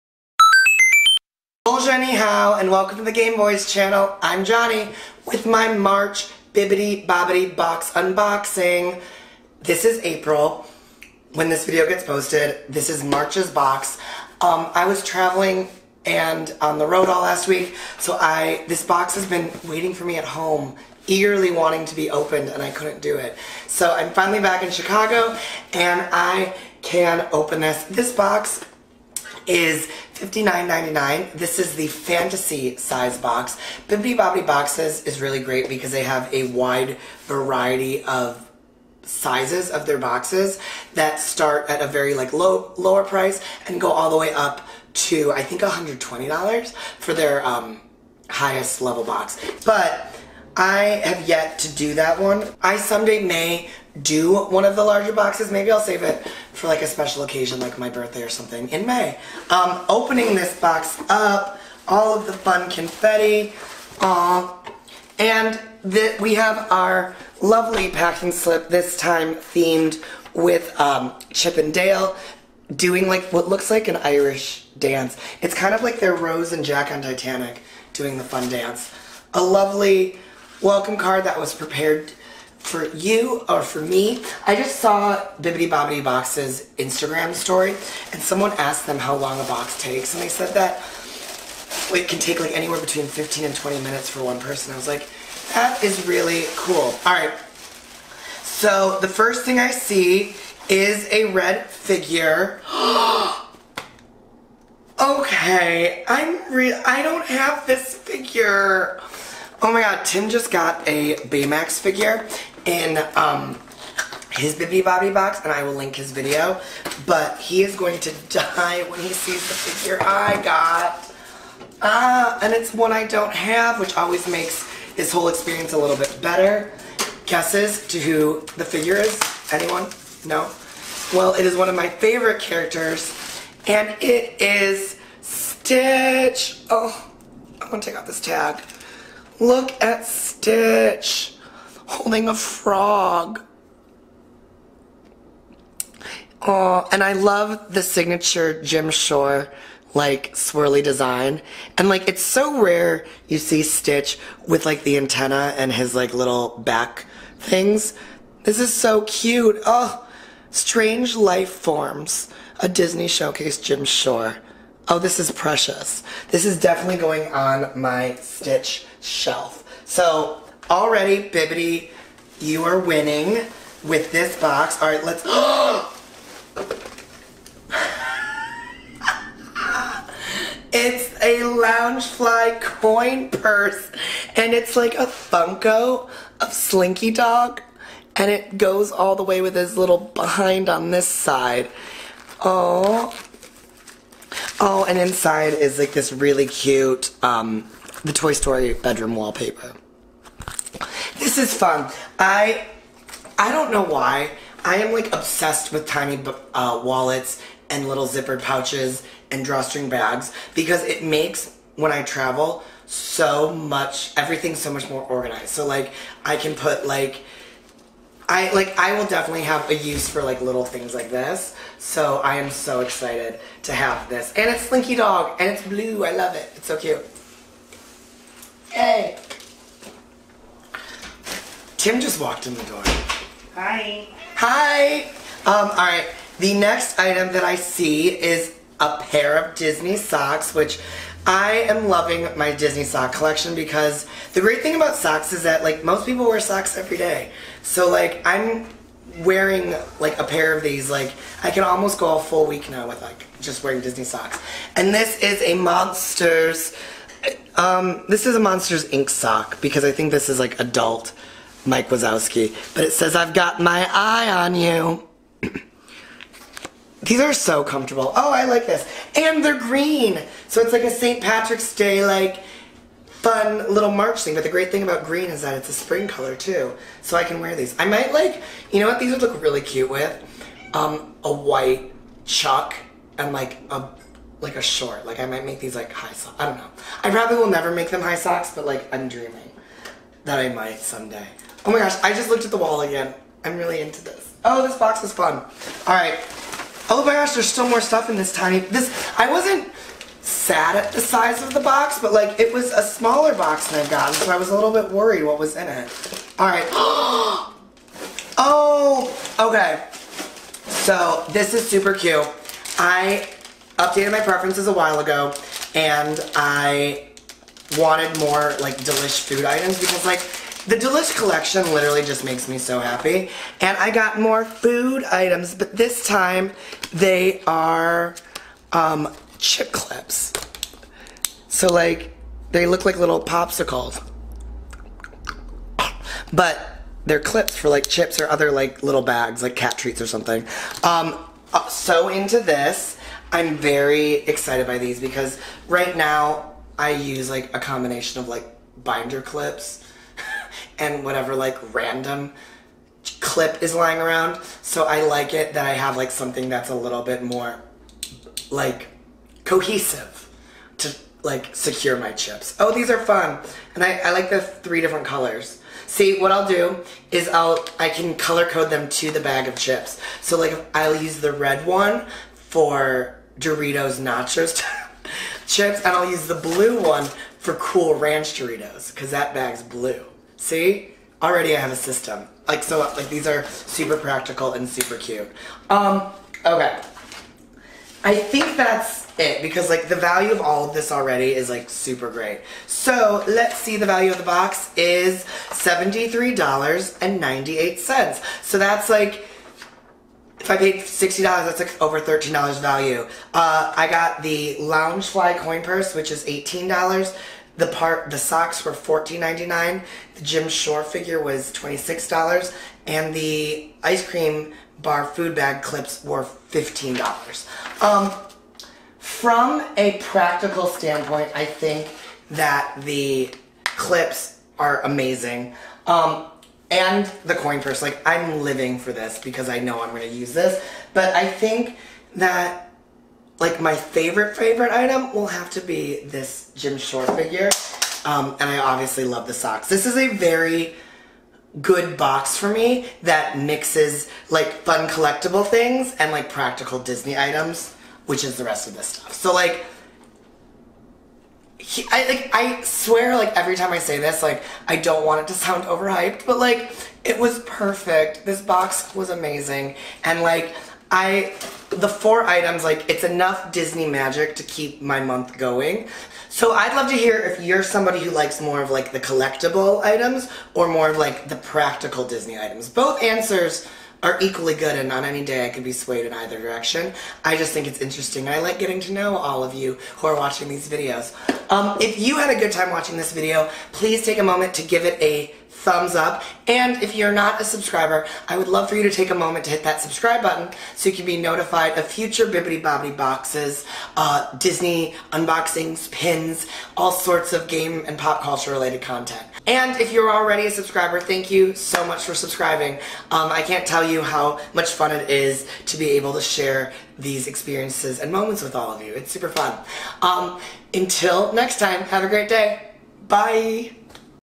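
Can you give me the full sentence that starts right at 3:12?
Oh, Oh, and inside is like this really cute, um, the Toy Story bedroom wallpaper.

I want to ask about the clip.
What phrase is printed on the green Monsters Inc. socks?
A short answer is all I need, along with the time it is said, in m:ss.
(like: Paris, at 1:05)
I've got my eye on you, at 4:23.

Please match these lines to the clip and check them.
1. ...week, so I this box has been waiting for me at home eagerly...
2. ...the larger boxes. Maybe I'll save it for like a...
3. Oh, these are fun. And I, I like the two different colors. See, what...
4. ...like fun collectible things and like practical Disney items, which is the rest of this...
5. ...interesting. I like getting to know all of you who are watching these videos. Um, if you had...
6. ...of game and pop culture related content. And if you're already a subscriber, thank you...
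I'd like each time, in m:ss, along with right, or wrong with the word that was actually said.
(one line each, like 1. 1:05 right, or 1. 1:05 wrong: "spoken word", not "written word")
1. 0:17 right
2. 0:54 right
3. 6:02 wrong: "three", not "two"
4. 7:24 right
5. 7:57 right
6. 8:17 right.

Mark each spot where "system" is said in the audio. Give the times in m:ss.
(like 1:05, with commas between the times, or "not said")
6:21.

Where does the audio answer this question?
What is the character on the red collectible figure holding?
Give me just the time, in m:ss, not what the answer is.
2:22.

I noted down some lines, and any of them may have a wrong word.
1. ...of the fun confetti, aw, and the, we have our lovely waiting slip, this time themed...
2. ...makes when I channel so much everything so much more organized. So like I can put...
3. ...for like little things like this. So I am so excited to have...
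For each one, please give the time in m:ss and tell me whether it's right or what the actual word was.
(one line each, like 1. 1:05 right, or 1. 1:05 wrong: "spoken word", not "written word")
1. 1:02 wrong: "packing", not "waiting"
2. 3:31 wrong: "travel", not "channel"
3. 3:40 right.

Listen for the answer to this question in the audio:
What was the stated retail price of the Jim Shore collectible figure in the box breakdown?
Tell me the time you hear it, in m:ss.
6:51.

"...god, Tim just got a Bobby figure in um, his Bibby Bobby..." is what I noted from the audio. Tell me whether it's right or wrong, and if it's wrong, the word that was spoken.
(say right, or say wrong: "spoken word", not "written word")
wrong: "Baymax", not "Bobby".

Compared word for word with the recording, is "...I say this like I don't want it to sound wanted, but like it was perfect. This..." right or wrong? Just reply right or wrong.
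wrong.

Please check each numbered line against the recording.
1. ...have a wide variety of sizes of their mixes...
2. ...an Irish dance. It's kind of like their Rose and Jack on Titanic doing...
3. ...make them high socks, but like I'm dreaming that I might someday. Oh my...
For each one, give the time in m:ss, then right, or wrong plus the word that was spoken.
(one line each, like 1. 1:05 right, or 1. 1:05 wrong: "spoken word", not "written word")
1. 0:36 wrong: "boxes", not "mixes"
2. 1:13 right
3. 4:47 right.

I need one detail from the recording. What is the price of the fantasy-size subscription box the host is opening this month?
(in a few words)
$59.99.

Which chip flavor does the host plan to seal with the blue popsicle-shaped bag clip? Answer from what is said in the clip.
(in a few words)
Cool Ranch Doritos.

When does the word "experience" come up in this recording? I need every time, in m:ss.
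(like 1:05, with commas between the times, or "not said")
2:05, 8:27.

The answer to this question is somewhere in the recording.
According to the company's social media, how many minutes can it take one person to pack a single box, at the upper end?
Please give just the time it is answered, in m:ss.
1:33.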